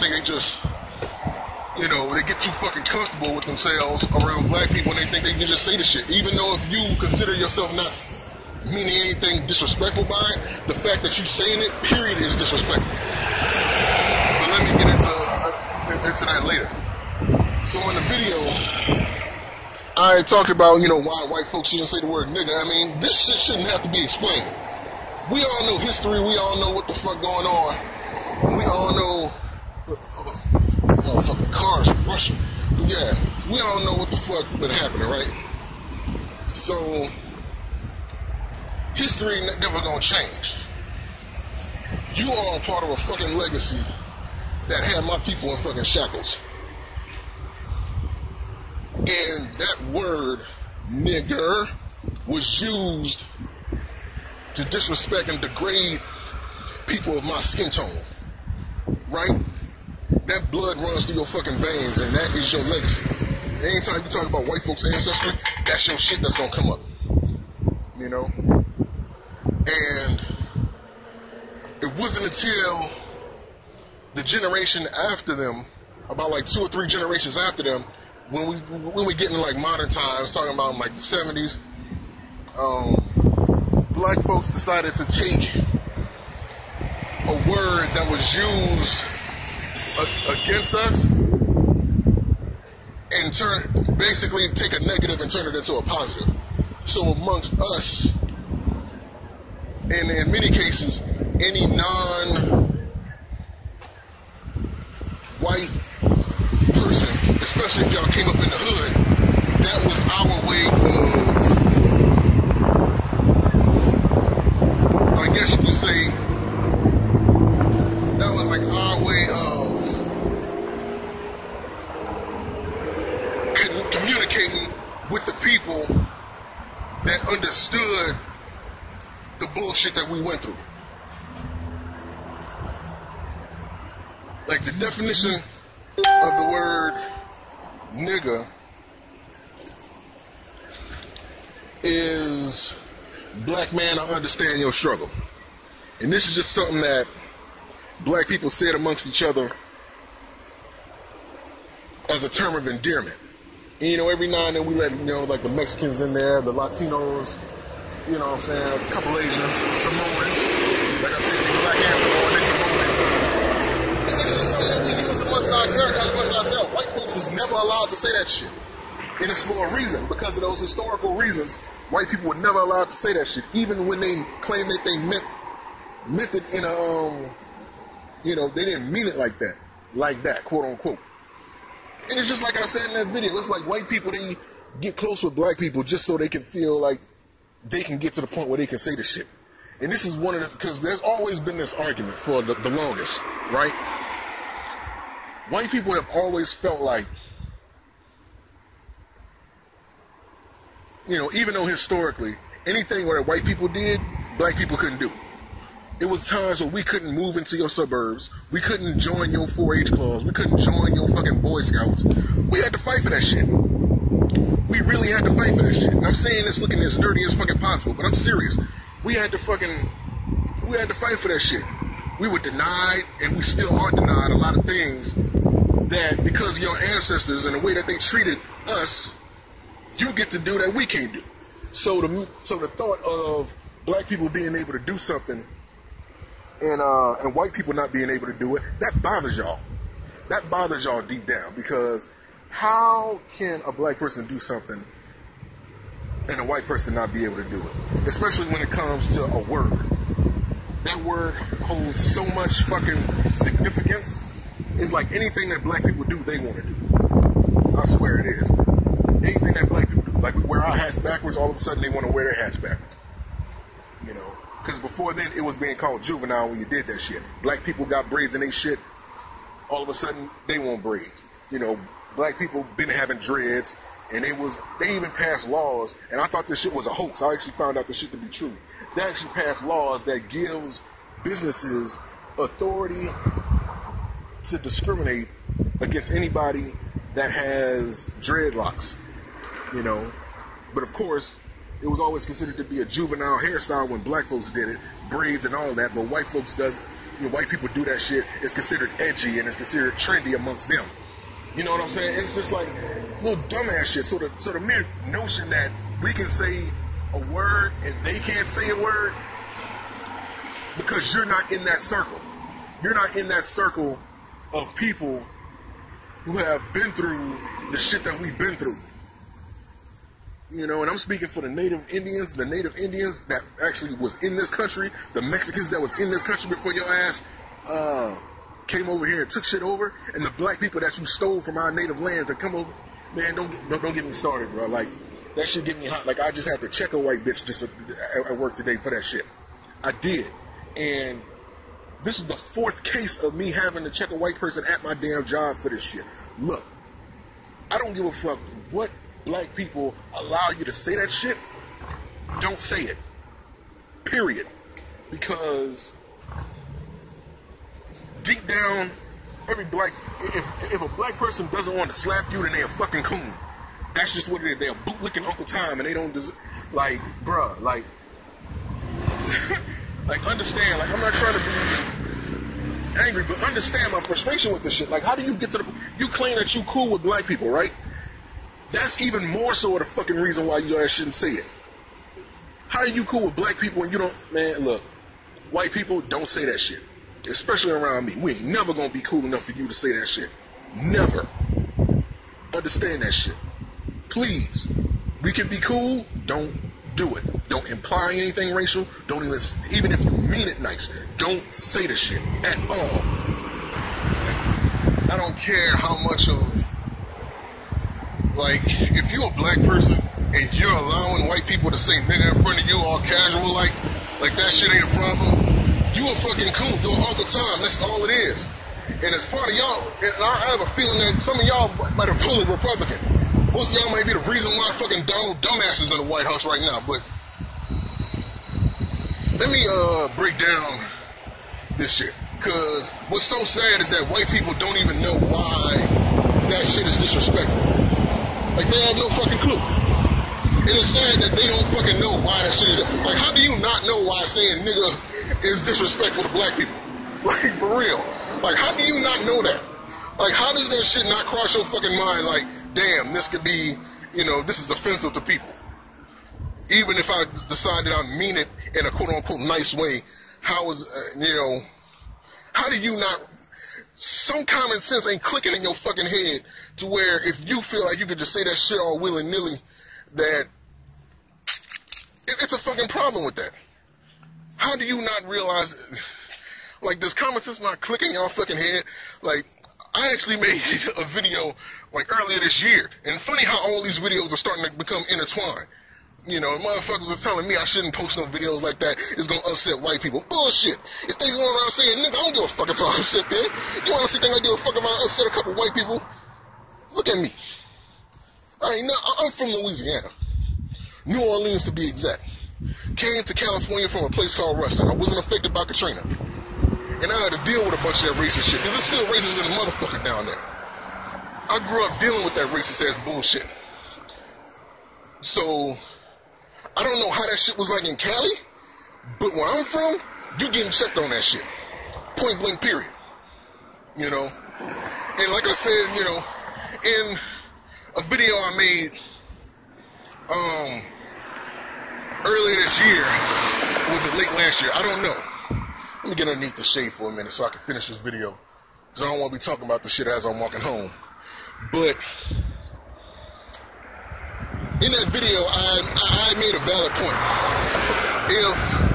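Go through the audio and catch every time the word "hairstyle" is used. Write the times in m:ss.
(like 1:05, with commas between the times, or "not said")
4:53.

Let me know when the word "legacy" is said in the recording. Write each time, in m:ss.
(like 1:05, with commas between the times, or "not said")
0:43, 1:02.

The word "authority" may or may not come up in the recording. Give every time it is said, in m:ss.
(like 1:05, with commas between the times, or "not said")
4:42.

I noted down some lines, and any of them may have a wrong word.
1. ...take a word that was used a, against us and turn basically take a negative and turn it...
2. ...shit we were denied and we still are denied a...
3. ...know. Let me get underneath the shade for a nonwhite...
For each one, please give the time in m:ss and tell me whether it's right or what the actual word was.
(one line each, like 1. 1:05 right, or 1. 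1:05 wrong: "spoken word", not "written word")
1. 1:25 right
2. 3:41 right
3. 8:55 wrong: "minute", not "nonwhite".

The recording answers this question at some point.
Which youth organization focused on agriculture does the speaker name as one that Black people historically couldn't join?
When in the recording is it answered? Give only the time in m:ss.
3:29.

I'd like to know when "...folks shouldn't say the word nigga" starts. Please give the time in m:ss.
0:21.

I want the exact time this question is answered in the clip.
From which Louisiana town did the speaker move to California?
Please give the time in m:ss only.
8:24.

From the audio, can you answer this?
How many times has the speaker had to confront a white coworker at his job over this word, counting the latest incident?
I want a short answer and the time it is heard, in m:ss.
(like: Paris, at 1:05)
4, at 5:42.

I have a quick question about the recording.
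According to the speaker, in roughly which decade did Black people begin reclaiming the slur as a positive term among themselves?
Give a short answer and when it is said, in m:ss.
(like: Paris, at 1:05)
the 70s, at 1:20.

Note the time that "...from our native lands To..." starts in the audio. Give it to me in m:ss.
5:31.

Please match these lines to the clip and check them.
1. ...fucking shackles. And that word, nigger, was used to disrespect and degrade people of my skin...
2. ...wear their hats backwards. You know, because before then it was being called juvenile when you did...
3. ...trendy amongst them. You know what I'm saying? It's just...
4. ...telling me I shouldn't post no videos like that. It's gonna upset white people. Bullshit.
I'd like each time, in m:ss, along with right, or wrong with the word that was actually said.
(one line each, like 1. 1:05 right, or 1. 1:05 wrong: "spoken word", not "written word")
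1. 0:45 right
2. 4:22 right
3. 4:59 right
4. 8:07 right.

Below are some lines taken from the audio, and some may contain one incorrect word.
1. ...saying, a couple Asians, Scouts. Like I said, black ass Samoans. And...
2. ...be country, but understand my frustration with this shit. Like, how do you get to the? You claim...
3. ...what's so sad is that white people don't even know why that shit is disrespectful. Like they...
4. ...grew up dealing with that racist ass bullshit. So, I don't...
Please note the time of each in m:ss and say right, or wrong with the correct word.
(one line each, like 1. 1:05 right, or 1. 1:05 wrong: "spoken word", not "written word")
1. 2:38 wrong: "Samoans", not "Scouts"
2. 6:11 wrong: "angry", not "country"
3. 7:13 right
4. 8:31 right.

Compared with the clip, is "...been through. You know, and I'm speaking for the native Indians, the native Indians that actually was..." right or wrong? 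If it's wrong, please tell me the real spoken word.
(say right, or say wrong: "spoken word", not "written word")
right.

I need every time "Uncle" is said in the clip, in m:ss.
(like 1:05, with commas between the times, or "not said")
6:05, 6:57.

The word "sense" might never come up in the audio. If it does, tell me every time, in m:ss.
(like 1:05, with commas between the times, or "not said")
7:44, 7:57.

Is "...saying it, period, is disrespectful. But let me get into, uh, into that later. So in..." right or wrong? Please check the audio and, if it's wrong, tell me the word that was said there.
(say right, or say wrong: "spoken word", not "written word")
right.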